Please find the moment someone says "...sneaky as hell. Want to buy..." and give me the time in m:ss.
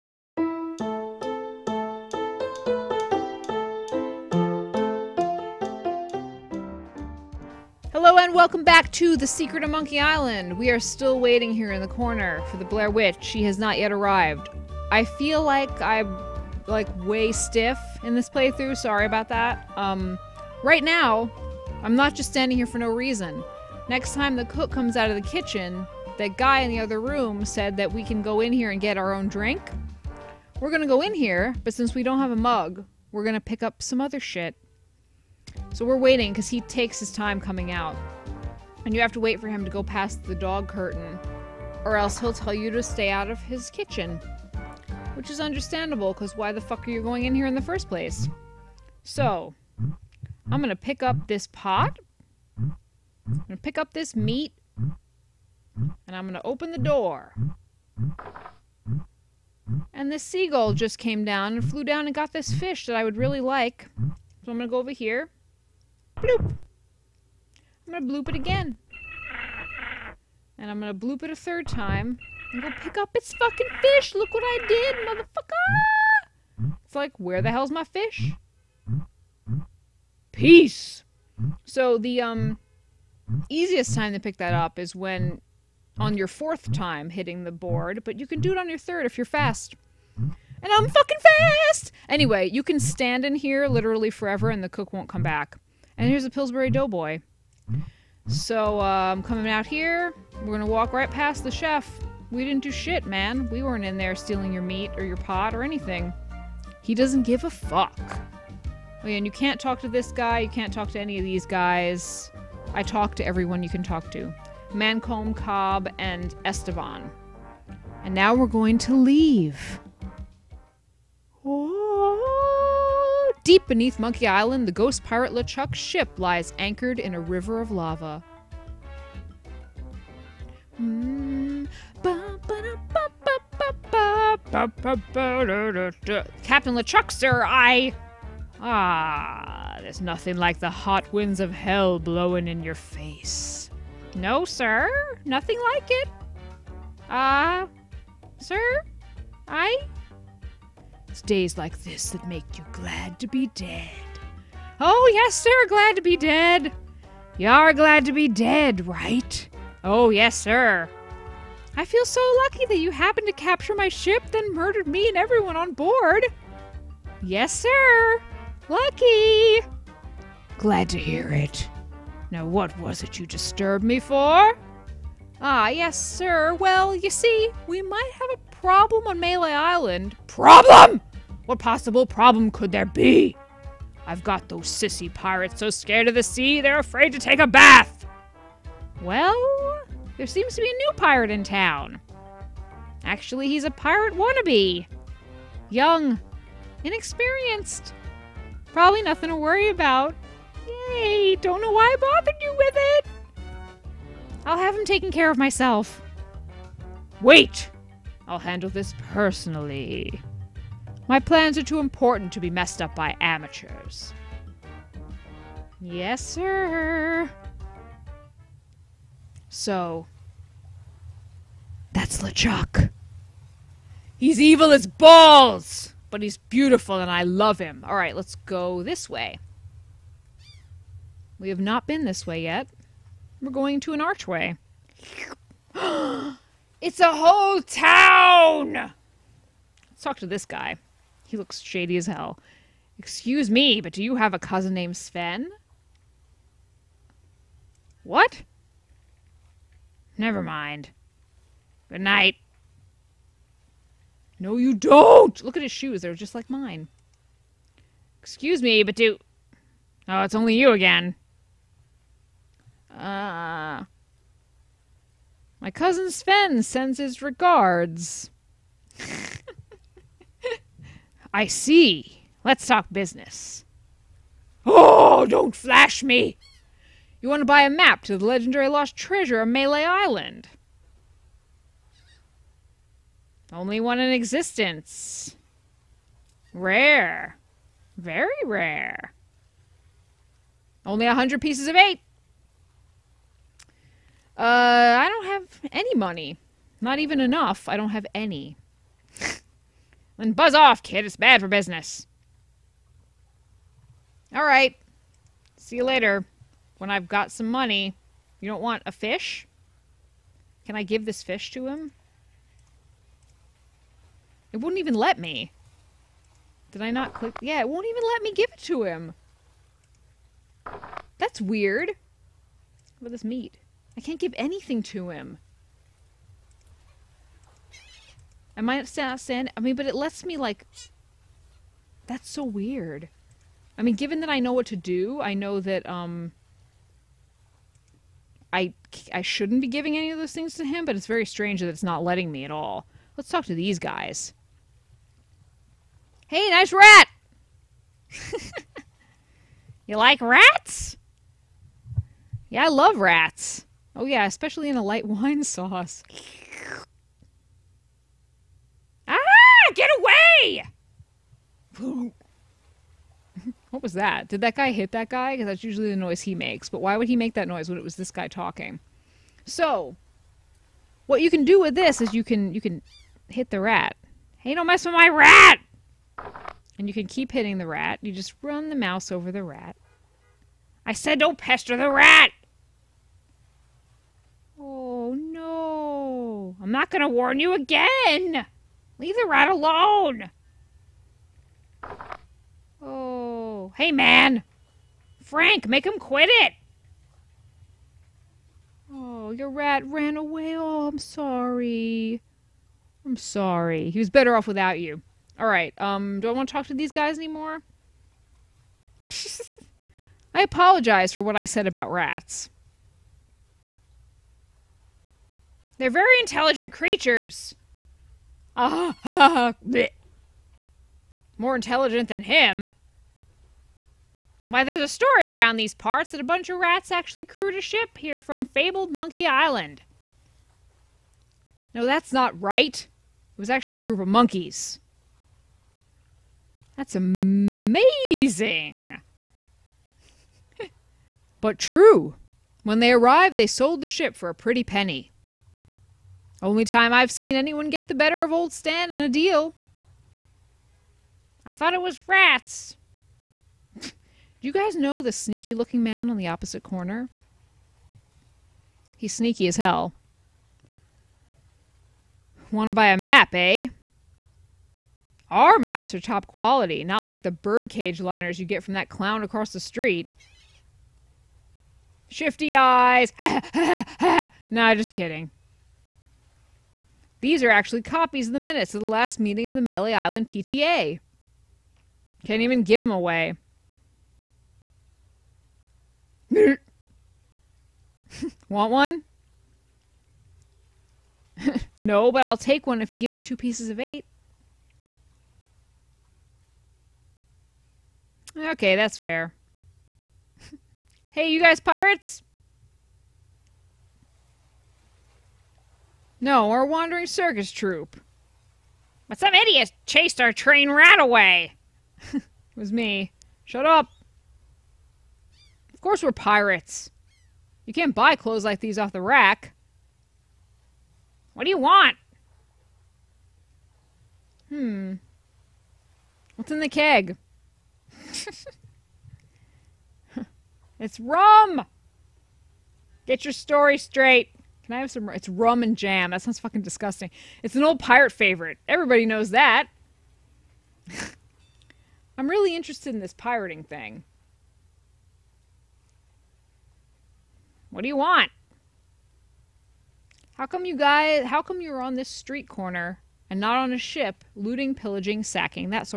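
7:39.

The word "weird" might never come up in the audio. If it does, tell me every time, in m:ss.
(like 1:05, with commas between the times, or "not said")
5:21, 5:32.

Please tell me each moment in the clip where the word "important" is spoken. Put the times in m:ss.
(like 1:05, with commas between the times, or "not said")
3:31.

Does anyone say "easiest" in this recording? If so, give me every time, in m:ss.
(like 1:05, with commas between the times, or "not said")
1:23.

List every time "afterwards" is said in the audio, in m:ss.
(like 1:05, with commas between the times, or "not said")
not said.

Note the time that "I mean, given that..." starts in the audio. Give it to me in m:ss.
5:33.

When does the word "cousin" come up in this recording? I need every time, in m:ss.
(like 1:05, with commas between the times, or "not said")
4:04, 4:25.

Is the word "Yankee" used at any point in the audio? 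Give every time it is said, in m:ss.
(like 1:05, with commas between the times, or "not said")
not said.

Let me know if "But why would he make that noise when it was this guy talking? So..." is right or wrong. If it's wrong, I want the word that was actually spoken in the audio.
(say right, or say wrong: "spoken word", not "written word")
right.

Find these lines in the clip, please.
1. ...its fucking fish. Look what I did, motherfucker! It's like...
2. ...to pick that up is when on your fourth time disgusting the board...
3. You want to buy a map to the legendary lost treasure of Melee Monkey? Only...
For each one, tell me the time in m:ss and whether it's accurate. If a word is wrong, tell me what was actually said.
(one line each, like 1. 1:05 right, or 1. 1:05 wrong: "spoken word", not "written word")
1. 1:13 right
2. 1:24 wrong: "hitting", not "disgusting"
3. 4:37 wrong: "Island", not "Monkey".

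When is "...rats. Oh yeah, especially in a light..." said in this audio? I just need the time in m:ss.
5:52.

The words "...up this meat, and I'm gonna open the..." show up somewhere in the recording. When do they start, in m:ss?
0:53.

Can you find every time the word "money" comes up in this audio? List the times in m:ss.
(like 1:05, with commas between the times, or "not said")
4:55, 5:07.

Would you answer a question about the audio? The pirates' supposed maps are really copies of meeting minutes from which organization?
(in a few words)
Melee Island PTA.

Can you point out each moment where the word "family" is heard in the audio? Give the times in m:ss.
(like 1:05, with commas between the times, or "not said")
not said.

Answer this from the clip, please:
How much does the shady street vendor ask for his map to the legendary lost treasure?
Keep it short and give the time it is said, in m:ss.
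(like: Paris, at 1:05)
100 pieces of eight, at 4:51.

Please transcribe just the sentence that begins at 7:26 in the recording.
Only time I've seen anyone get the better of old Stan in a deal.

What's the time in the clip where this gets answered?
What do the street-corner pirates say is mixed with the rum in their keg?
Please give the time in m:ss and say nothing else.
8:55.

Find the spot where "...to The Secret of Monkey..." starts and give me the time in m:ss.
0:08.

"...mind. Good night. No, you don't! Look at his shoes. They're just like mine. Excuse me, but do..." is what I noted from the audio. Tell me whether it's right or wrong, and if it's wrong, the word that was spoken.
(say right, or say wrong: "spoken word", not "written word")
right.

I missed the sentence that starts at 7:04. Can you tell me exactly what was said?
Why, there's a story around these parts that a bunch of rats actually crewed a ship here from fabled Monkey Island.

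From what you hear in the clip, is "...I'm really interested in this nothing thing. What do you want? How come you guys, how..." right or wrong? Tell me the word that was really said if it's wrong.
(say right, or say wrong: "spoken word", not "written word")
wrong: "pirating", not "nothing".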